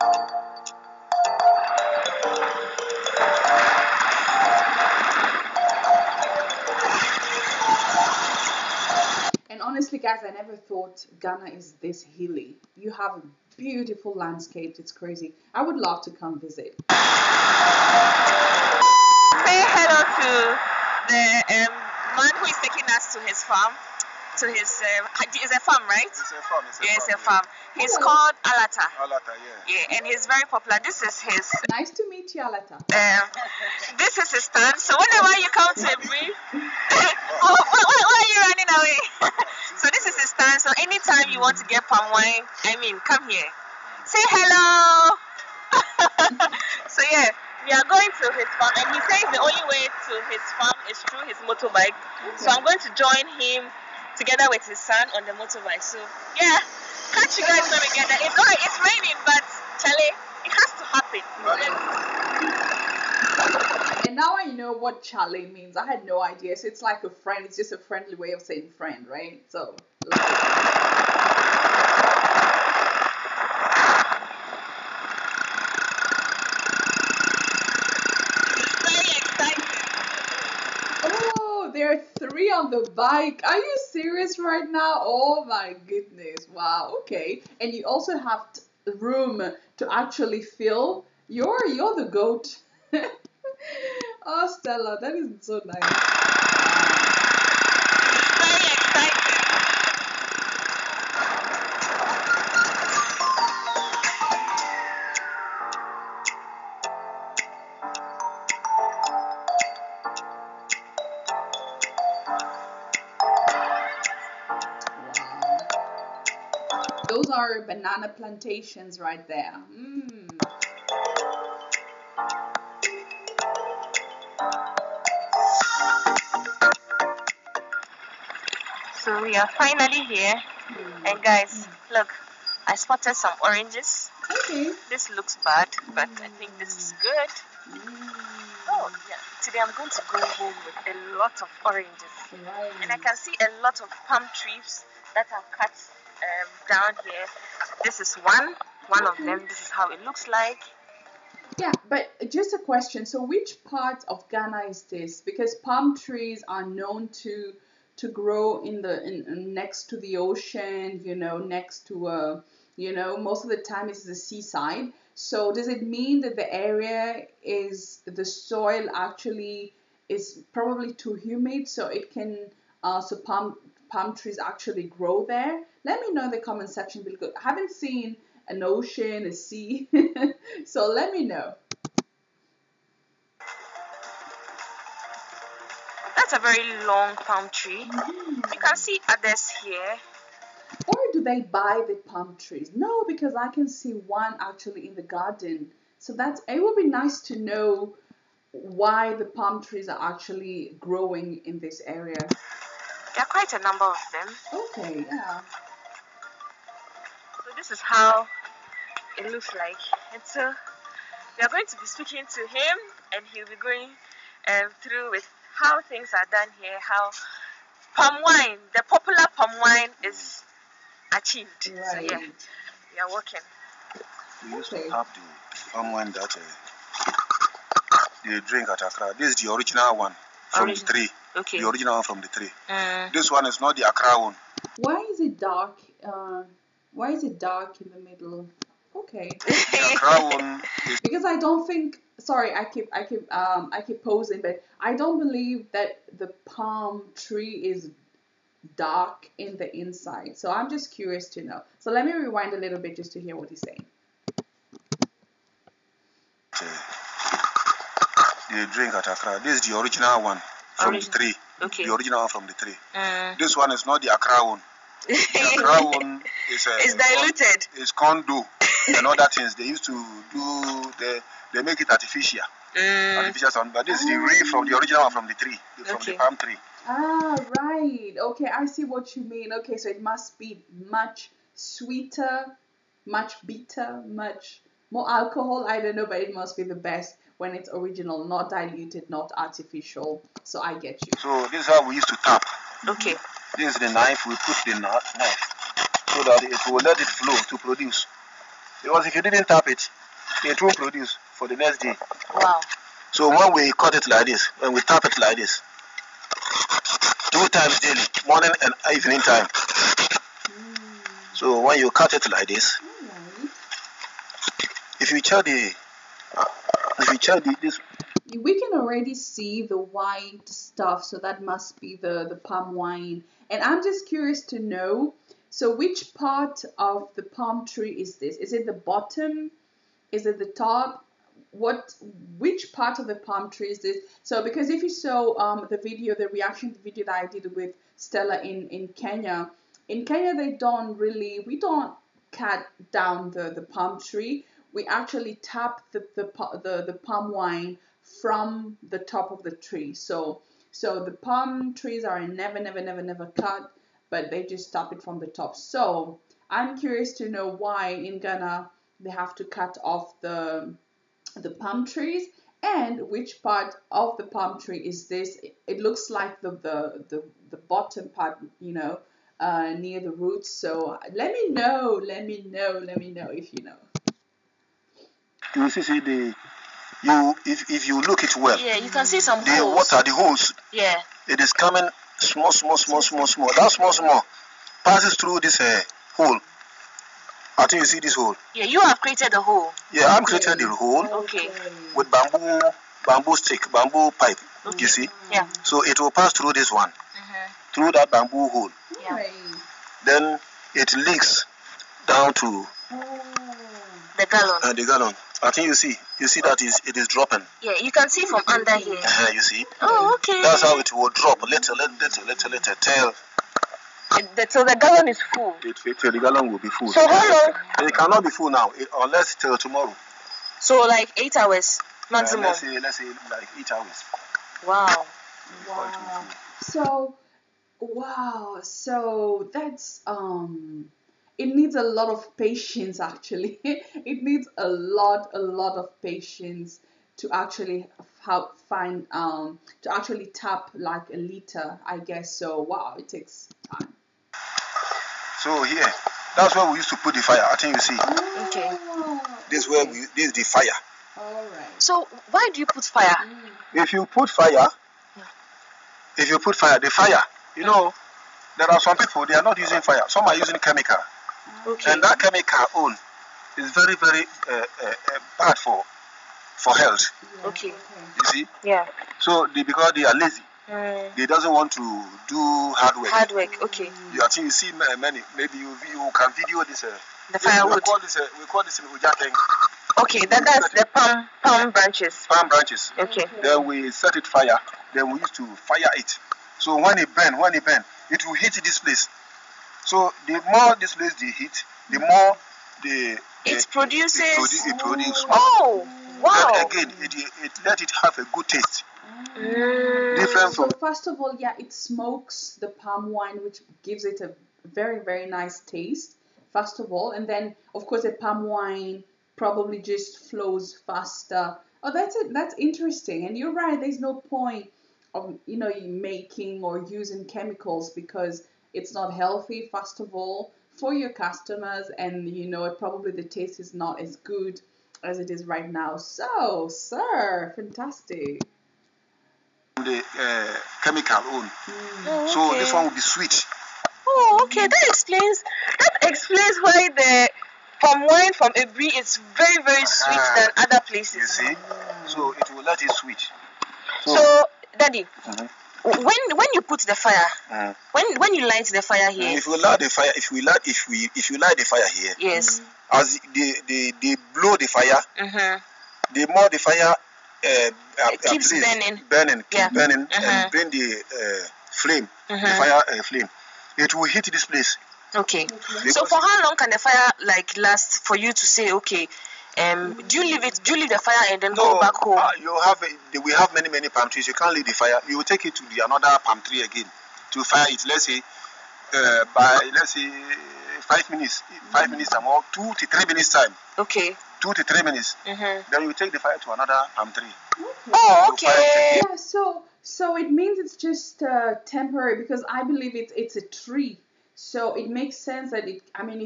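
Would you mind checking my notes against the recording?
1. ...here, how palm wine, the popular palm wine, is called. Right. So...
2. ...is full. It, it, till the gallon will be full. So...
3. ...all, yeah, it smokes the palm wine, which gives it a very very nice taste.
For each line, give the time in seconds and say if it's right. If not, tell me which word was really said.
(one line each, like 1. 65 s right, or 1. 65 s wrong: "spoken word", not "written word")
1. 216 s wrong: "achieved", not "called"
2. 415 s right
3. 501 s right.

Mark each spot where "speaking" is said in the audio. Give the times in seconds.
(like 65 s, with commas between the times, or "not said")
211 s.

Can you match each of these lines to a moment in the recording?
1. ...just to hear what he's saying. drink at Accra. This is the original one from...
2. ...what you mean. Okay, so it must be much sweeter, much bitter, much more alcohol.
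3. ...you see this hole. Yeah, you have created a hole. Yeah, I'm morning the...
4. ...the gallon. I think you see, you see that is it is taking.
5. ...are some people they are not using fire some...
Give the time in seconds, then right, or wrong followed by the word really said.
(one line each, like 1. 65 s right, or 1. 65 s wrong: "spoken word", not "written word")
1. 252 s right
2. 278 s right
3. 387 s wrong: "creating", not "morning"
4. 404 s wrong: "dropping", not "taking"
5. 458 s right.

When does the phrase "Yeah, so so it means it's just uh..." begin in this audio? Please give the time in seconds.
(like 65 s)
589 s.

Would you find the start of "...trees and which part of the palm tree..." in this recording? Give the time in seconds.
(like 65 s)
361 s.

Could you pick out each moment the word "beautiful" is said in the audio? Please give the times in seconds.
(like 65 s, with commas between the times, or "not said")
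13 s.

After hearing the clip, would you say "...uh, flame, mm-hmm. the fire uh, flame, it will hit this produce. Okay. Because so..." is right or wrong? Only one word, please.
wrong.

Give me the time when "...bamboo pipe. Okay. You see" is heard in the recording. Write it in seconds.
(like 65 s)
393 s.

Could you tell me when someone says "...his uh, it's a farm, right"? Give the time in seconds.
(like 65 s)
24 s.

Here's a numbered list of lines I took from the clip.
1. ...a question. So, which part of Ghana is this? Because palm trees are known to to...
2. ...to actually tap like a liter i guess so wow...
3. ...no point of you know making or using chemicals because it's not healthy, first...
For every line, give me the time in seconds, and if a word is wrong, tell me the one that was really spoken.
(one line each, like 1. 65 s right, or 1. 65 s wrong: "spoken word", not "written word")
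1. 152 s right
2. 439 s right
3. 513 s right.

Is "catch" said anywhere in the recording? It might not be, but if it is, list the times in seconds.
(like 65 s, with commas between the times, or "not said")
57 s.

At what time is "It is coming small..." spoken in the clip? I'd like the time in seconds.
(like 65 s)
381 s.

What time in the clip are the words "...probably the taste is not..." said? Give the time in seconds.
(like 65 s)
522 s.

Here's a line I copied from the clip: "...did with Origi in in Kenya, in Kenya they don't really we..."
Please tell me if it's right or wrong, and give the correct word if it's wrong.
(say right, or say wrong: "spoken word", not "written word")
wrong: "Stella", not "Origi".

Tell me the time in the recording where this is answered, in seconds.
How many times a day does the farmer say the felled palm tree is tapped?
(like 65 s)
307 s.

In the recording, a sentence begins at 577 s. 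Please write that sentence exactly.
Let's say uh, by let's say five minutes, five minutes or or two to three minutes time.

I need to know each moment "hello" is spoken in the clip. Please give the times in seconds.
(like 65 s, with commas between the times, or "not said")
19 s, 44 s.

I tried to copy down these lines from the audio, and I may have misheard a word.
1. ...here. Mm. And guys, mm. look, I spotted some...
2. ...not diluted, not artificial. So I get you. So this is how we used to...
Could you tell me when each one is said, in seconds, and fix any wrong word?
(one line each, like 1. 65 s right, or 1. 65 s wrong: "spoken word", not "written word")
1. 130 s right
2. 288 s right.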